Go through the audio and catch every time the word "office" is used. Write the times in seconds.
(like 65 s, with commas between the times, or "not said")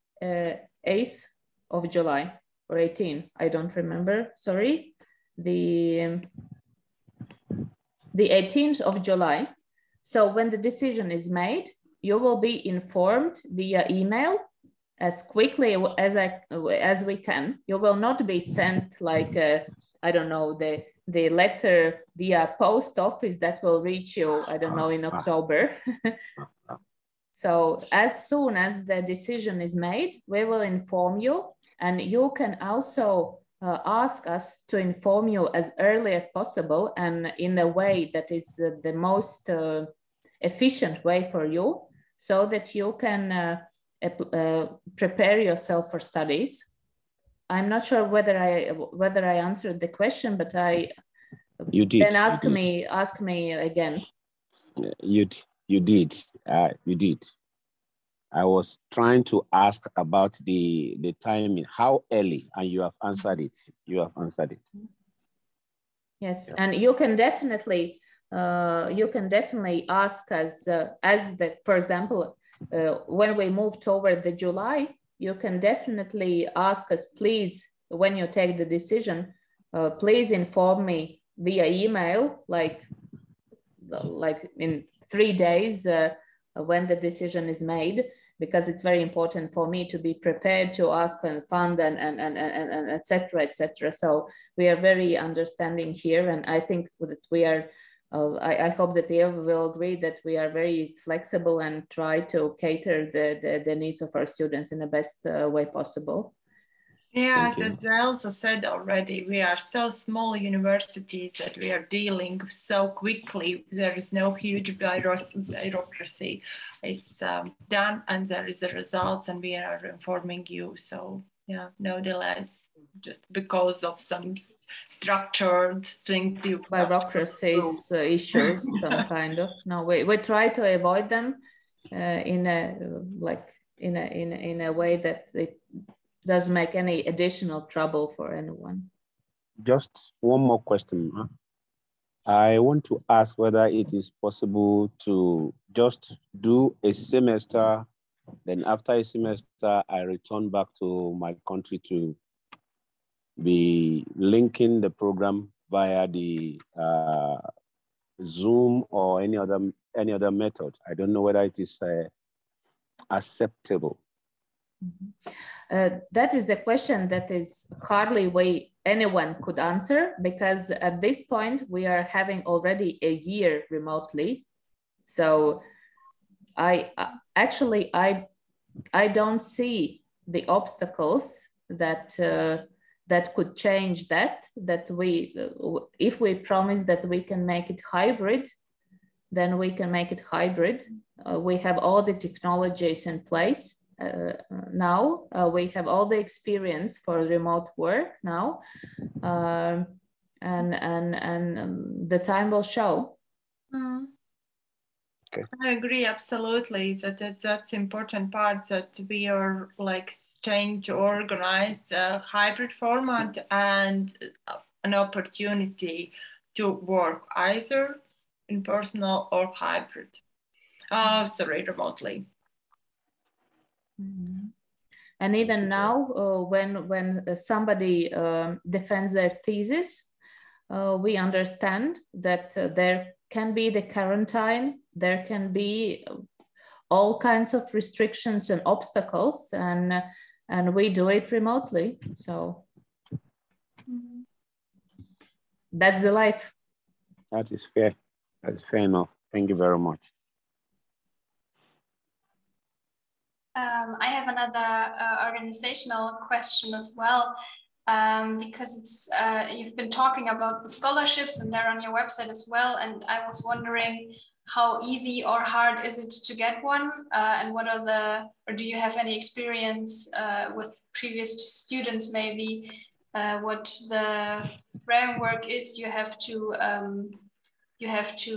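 22 s.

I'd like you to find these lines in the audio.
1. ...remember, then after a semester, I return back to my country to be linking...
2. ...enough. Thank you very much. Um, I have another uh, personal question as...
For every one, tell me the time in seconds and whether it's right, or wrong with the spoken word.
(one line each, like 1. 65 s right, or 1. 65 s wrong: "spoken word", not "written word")
1. 146 s wrong: "semester", not "remember"
2. 248 s wrong: "organizational", not "personal".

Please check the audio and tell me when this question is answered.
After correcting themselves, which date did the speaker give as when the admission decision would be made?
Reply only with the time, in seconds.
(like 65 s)
8 s.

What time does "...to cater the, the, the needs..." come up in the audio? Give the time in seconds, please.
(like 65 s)
102 s.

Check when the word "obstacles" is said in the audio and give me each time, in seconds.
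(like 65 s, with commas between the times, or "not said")
180 s, 238 s.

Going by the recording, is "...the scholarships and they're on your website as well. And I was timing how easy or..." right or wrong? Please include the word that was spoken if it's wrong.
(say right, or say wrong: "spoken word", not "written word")
wrong: "wondering", not "timing".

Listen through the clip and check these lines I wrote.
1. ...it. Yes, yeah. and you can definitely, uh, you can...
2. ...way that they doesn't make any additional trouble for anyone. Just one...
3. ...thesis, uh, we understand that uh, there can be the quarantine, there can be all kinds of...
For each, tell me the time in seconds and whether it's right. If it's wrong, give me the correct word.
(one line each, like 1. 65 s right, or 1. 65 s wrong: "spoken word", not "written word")
1. 64 s right
2. 134 s right
3. 229 s right.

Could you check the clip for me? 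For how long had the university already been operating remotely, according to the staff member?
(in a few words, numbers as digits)
a year.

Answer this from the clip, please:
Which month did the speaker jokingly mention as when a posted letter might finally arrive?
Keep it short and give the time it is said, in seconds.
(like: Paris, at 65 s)
October, at 25 s.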